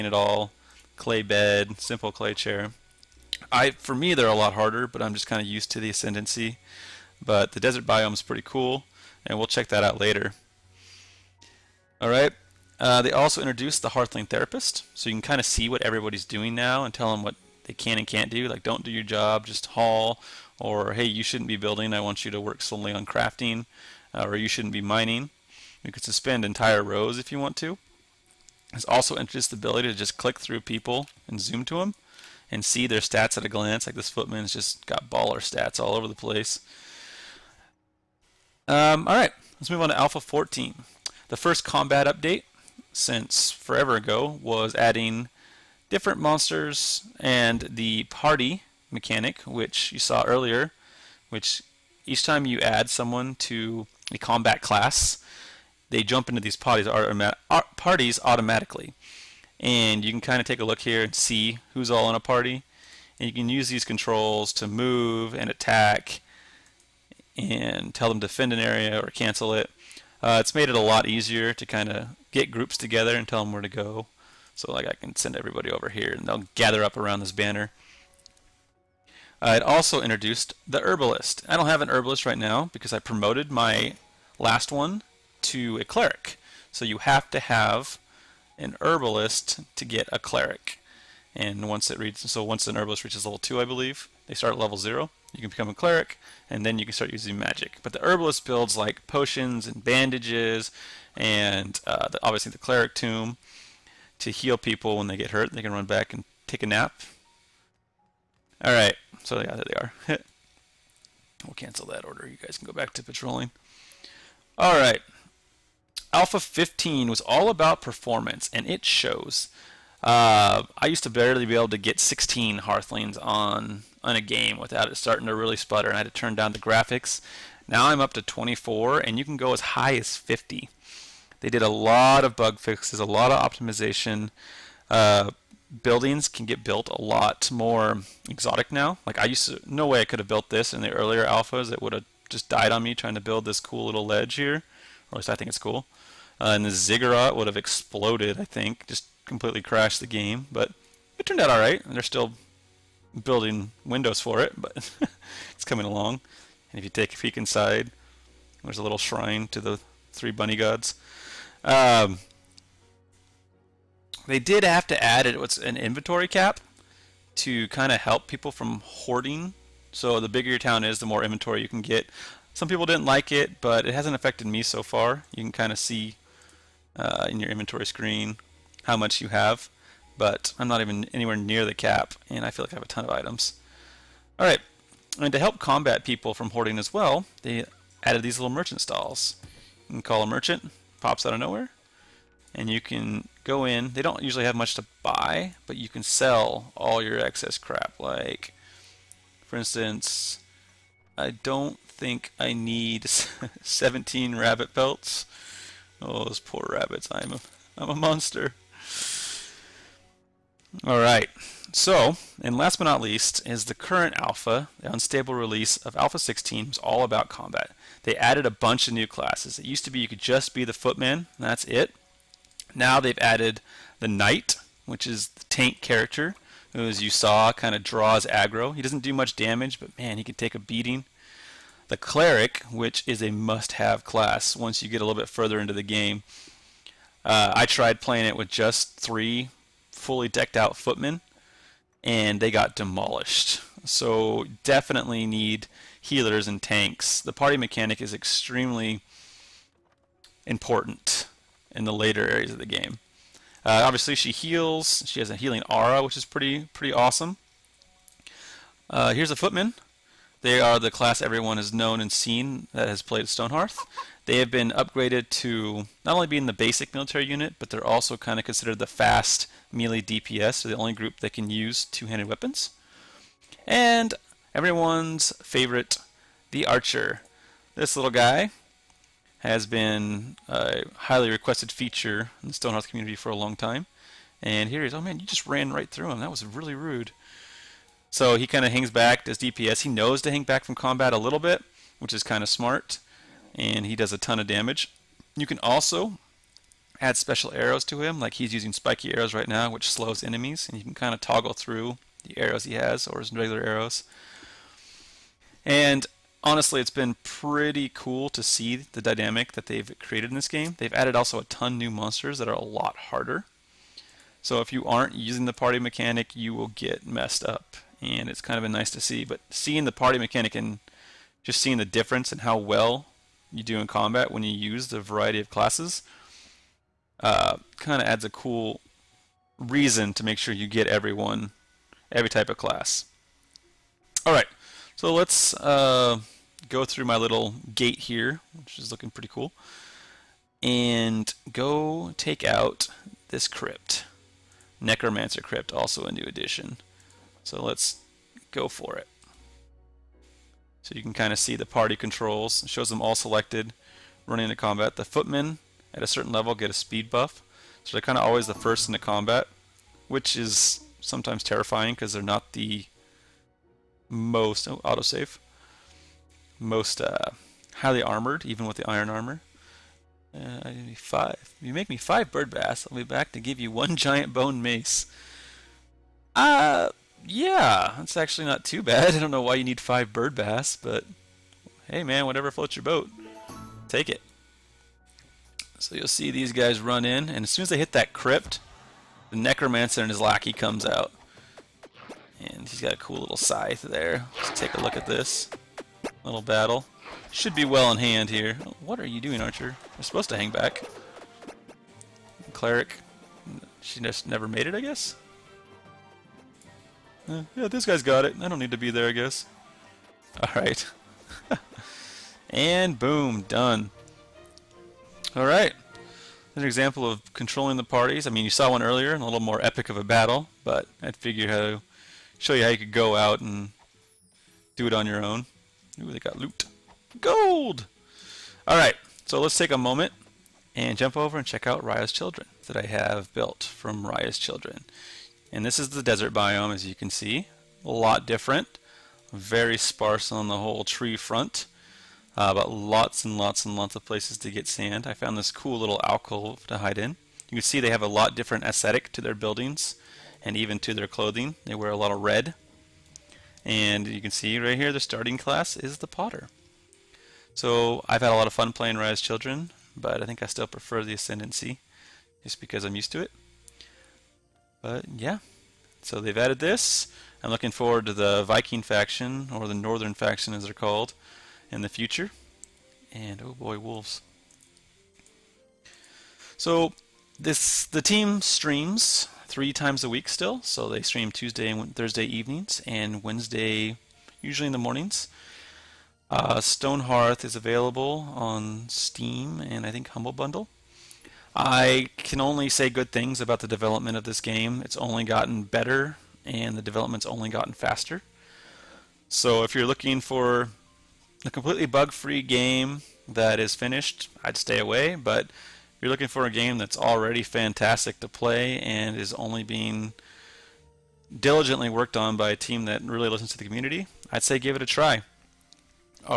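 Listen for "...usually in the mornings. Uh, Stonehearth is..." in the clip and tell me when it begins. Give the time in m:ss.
8:04.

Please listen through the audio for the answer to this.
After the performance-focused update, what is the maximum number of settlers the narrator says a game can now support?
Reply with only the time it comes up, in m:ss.
2:10.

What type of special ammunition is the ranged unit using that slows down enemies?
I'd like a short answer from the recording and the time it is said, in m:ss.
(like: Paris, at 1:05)
spiky arrows, at 4:58.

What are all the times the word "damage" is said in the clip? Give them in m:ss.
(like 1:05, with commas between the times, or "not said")
3:49, 4:54.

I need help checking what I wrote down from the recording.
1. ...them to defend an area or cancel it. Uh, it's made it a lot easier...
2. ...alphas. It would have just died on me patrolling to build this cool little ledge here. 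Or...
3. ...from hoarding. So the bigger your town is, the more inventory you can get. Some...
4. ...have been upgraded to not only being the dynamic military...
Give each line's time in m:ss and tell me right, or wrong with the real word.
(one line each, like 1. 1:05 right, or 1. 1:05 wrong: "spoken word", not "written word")
1. 1:08 right
2. 2:21 wrong: "trying", not "patrolling"
3. 2:48 right
4. 4:24 wrong: "basic", not "dynamic".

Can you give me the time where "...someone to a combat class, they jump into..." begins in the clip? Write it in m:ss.
0:52.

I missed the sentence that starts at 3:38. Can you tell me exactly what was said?
They added a bunch of new classes.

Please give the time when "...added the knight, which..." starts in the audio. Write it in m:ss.
3:43.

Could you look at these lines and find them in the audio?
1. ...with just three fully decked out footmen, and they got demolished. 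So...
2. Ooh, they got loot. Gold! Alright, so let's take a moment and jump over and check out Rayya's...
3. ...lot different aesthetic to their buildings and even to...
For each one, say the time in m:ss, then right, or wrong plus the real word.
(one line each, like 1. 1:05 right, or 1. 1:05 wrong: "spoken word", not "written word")
1. 3:58 right
2. 7:06 right
3. 7:28 right.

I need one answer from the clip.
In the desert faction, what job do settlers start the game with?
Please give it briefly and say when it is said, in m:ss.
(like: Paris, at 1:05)
potter, at 7:35.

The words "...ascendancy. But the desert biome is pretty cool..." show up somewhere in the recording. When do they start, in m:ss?
0:05.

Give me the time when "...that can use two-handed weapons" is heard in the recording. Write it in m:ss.
4:31.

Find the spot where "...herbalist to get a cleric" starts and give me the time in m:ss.
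1:28.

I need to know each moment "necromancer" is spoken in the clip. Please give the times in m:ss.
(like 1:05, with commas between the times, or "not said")
5:44, 6:29.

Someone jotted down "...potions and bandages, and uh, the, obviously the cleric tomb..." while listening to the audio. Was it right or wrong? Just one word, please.
right.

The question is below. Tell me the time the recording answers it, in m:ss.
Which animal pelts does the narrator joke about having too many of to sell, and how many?
3:23.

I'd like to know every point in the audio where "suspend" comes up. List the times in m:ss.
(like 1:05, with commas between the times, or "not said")
0:26.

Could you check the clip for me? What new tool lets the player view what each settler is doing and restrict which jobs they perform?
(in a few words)
Hearthling Therapist.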